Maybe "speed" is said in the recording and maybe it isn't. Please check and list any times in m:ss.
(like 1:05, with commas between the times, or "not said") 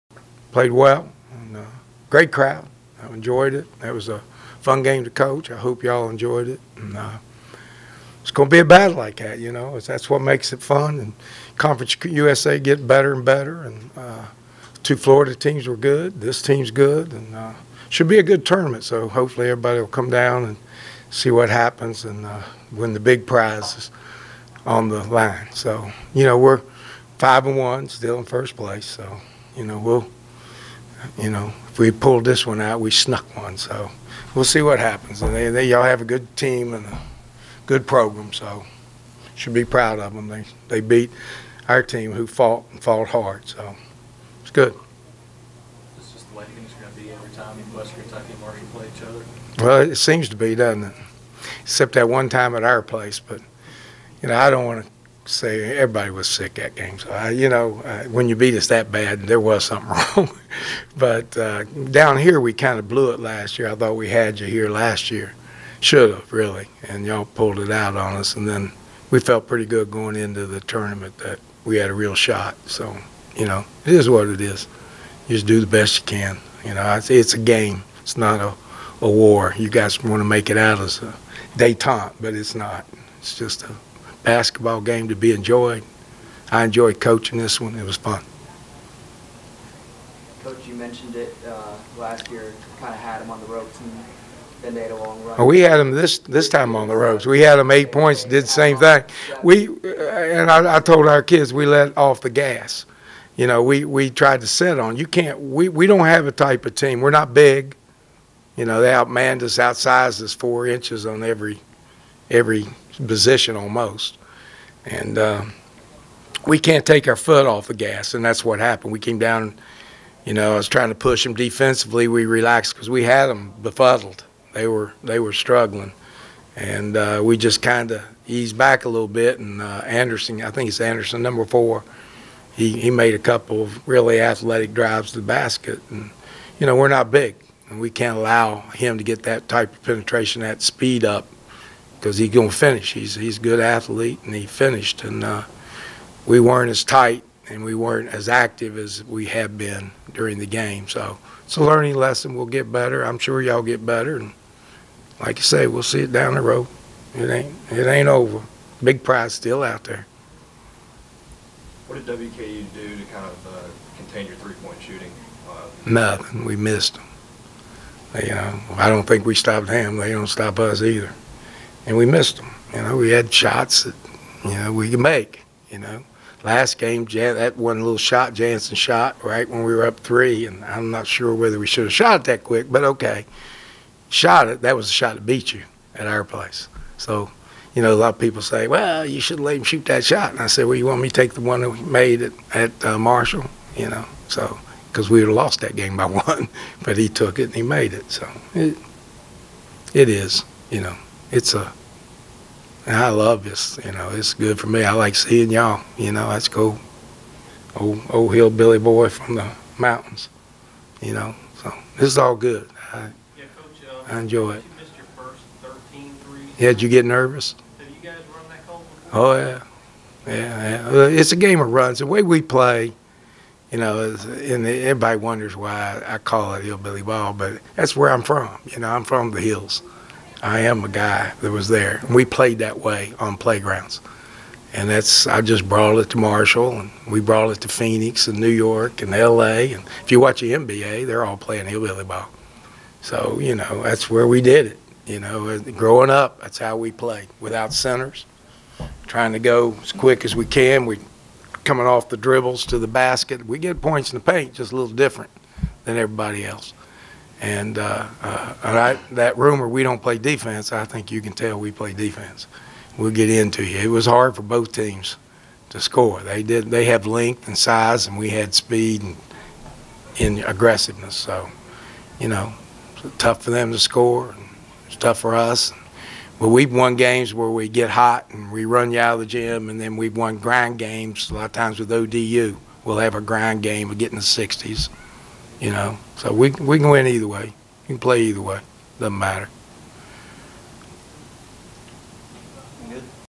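2:20, 4:28.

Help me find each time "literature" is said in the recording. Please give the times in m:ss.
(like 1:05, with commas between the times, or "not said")
not said.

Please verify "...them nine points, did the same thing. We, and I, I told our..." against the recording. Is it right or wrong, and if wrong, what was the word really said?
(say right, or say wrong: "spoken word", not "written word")
wrong: "eight", not "nine".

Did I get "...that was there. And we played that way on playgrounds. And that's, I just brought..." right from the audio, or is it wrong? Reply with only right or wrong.
right.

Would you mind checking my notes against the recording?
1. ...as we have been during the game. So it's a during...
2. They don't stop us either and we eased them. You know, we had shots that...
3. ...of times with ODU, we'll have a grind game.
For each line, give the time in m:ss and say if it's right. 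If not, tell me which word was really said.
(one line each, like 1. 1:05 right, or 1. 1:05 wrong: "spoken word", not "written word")
1. 2:28 wrong: "learning", not "during"
2. 2:49 wrong: "missed", not "eased"
3. 4:41 right.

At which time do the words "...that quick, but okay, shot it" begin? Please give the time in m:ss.
3:02.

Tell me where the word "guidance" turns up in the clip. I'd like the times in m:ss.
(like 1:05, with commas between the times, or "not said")
not said.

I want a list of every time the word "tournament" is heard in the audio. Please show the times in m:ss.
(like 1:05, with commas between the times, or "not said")
0:18, 1:10.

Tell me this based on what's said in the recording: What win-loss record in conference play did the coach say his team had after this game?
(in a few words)
5-1.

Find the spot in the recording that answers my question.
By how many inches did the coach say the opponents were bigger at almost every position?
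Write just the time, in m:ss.
1:50.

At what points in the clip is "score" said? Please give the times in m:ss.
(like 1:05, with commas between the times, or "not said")
4:25, 4:33.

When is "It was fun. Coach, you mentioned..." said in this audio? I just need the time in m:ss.
1:27.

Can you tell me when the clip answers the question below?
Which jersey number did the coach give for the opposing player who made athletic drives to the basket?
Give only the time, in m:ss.
2:11.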